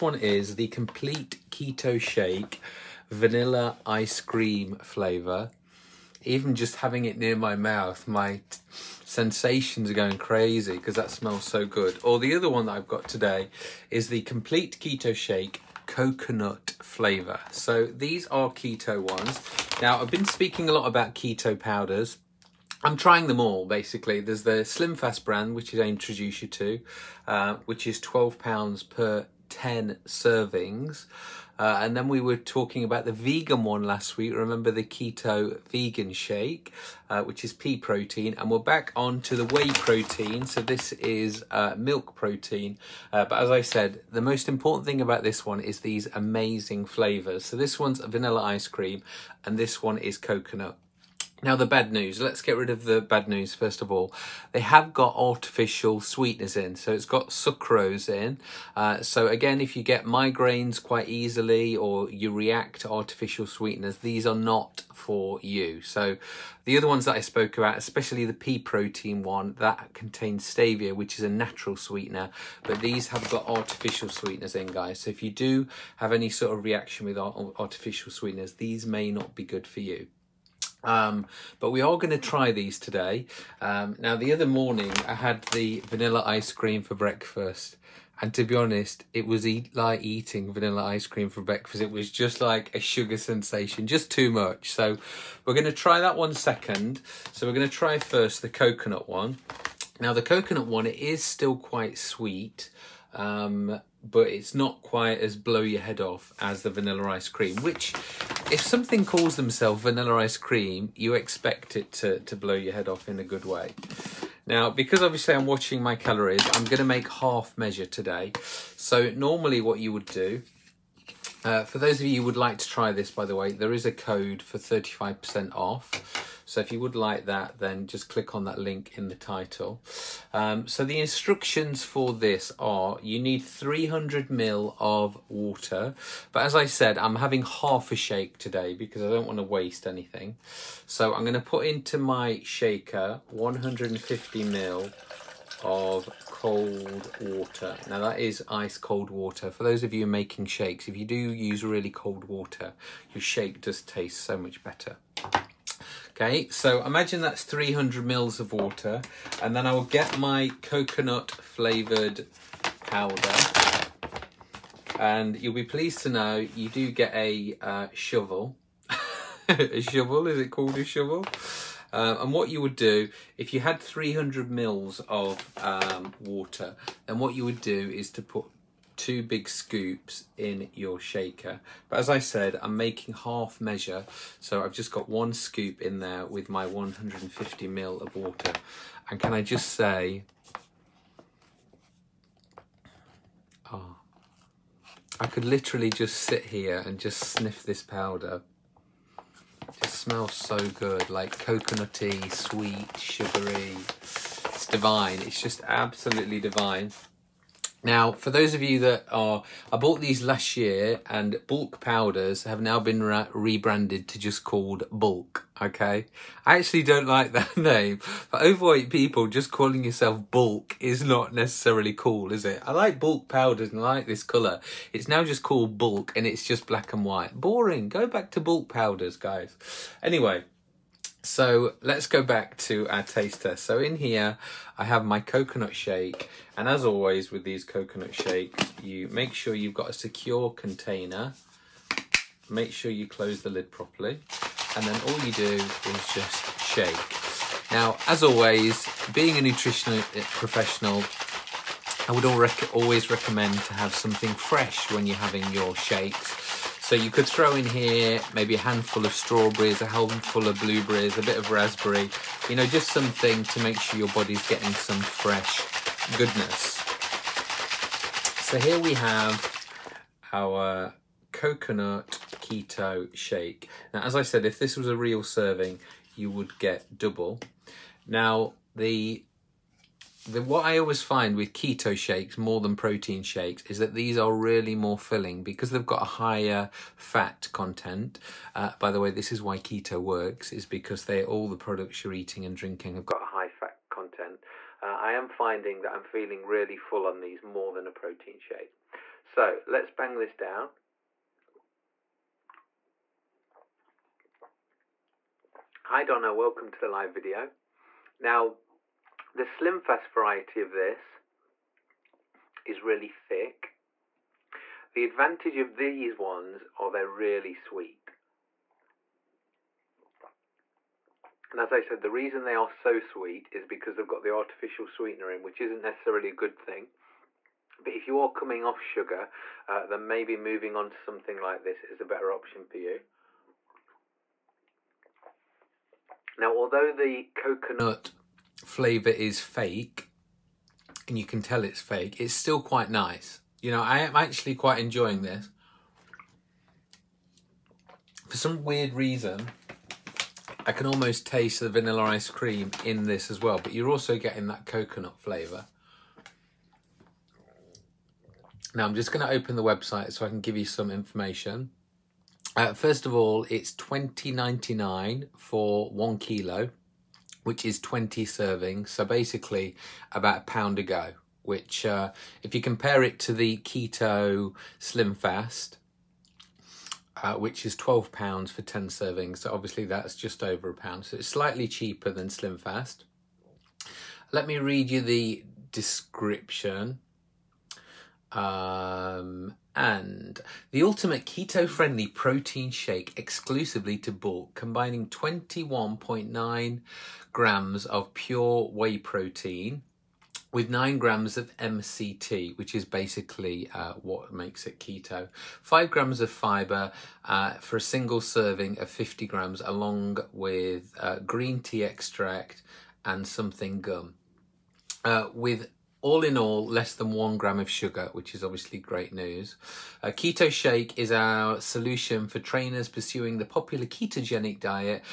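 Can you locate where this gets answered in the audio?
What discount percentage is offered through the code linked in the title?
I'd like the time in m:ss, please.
2:04.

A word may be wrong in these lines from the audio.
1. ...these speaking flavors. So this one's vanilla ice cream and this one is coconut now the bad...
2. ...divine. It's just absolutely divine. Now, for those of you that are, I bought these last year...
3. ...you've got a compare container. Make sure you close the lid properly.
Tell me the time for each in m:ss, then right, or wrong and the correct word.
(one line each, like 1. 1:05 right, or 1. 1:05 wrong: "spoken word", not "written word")
1. 0:45 wrong: "amazing", not "speaking"
2. 3:24 right
3. 3:59 wrong: "secure", not "compare".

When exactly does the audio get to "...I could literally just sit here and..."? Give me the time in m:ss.
3:15.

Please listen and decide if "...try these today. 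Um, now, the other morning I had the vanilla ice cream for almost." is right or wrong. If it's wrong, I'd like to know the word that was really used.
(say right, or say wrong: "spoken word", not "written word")
wrong: "breakfast", not "almost".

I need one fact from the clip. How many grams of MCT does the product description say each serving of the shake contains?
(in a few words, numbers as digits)
9 grams.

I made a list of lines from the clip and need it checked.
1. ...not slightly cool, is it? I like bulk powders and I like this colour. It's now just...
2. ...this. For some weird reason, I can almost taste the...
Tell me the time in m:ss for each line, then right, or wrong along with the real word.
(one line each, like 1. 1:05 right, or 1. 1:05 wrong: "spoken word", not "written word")
1. 3:41 wrong: "necessarily", not "slightly"
2. 5:45 right.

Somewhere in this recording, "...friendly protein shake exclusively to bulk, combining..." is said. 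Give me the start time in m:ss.
6:31.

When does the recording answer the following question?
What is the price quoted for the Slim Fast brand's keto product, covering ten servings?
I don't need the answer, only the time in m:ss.
0:28.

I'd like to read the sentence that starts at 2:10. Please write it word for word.
Um, so the instructions for this are you need 300 mil of water.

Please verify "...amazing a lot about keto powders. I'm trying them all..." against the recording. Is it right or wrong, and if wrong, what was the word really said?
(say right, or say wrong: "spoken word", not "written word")
wrong: "speaking", not "amazing".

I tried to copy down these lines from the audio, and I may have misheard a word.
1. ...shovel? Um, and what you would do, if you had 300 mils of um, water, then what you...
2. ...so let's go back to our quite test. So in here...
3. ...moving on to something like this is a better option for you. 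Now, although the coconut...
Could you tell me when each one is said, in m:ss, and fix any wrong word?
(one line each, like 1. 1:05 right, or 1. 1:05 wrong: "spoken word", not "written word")
1. 2:50 right
2. 3:51 wrong: "taste", not "quite"
3. 5:30 right.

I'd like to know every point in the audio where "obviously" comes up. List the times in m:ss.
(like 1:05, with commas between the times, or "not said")
1:55, 6:19, 6:58.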